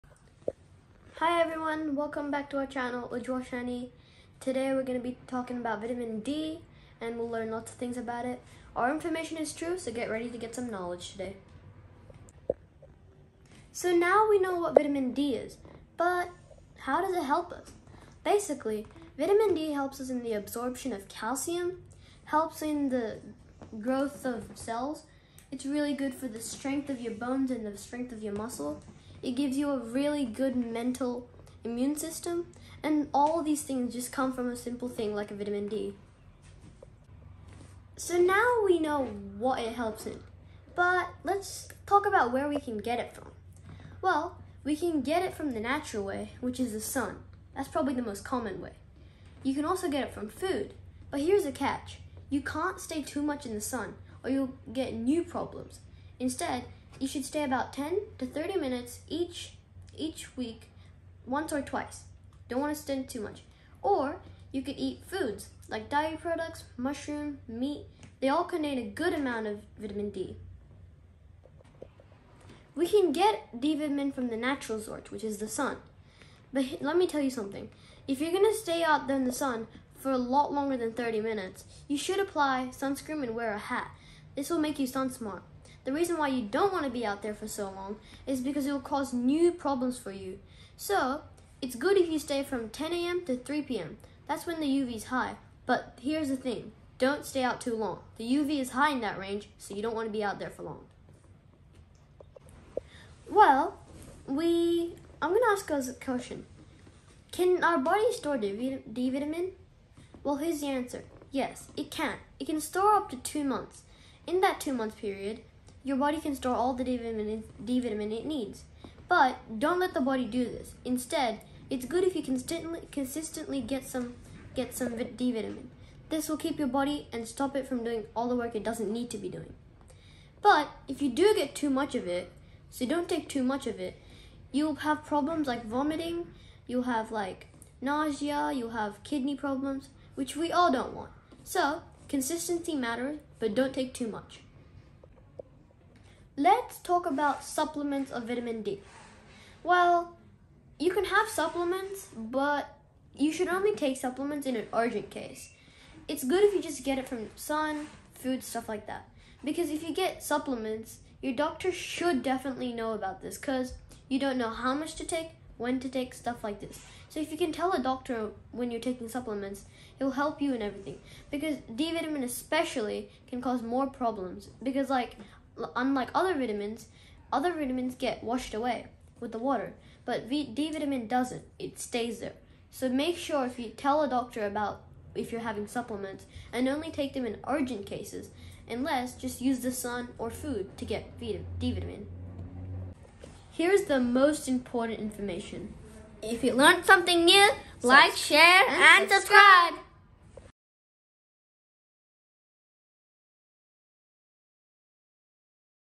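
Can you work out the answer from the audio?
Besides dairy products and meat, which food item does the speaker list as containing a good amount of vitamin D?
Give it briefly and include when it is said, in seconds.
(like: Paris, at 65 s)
mushroom, at 66 s.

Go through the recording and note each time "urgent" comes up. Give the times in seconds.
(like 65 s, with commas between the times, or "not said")
154 s, 187 s.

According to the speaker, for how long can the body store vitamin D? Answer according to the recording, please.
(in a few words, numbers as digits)
2 months.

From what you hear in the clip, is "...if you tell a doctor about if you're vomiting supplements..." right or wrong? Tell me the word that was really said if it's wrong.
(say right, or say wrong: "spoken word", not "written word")
wrong: "having", not "vomiting".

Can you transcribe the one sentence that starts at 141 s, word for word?
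So, consistency matters, but don't take too much.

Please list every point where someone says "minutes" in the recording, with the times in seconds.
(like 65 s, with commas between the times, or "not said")
58 s, 81 s.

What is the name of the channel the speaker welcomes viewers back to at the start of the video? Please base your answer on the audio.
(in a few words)
Ujwal Shanny.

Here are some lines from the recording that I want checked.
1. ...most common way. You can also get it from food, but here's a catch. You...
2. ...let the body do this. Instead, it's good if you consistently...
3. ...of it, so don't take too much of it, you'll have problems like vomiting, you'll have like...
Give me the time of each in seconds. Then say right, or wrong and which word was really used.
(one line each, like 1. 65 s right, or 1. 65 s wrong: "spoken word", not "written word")
1. 48 s right
2. 119 s right
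3. 131 s right.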